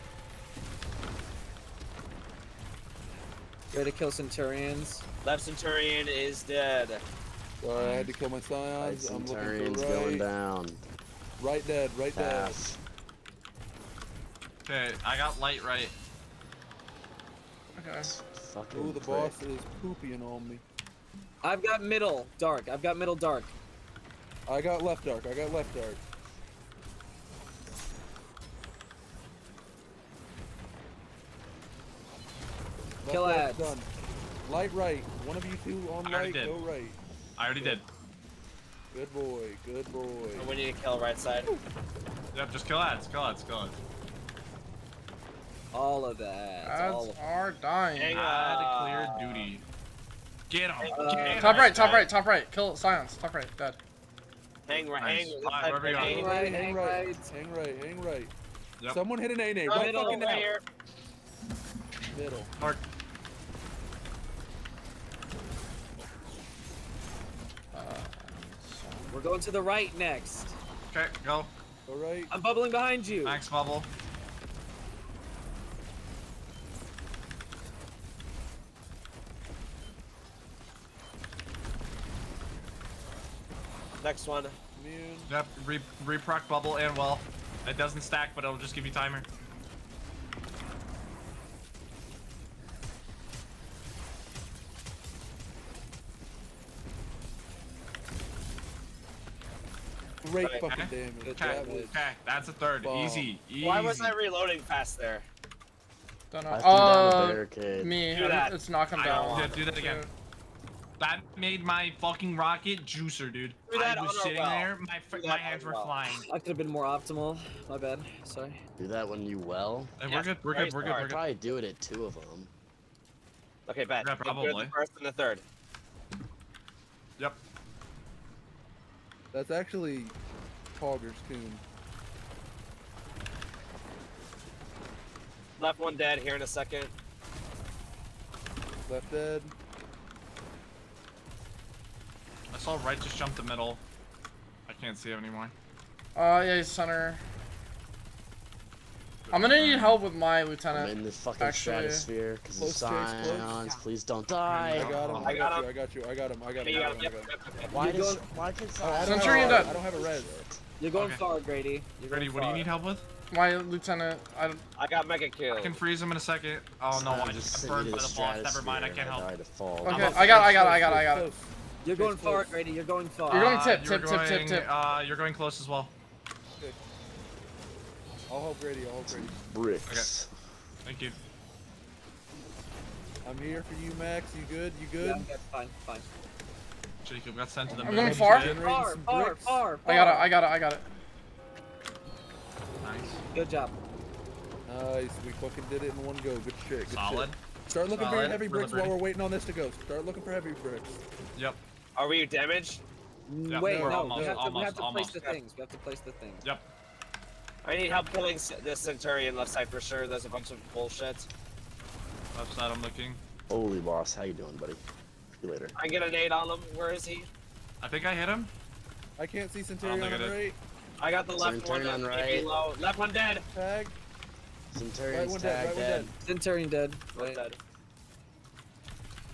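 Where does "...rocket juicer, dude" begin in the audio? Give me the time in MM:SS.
01:52.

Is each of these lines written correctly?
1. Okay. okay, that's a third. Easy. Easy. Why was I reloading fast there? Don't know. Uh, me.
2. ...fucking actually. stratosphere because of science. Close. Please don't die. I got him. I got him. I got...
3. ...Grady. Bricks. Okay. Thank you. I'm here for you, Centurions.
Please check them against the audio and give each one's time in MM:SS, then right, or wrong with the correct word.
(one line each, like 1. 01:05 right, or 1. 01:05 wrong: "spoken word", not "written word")
1. 01:41 right
2. 02:31 right
3. 02:59 wrong: "Max", not "Centurions".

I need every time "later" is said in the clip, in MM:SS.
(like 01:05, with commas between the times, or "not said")
03:35.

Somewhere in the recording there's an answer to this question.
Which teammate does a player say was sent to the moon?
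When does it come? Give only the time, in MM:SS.
03:07.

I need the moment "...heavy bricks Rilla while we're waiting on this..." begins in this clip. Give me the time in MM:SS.
03:18.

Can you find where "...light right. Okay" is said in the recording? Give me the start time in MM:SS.
00:15.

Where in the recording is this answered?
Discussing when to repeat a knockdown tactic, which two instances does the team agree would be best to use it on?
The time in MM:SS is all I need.
02:04.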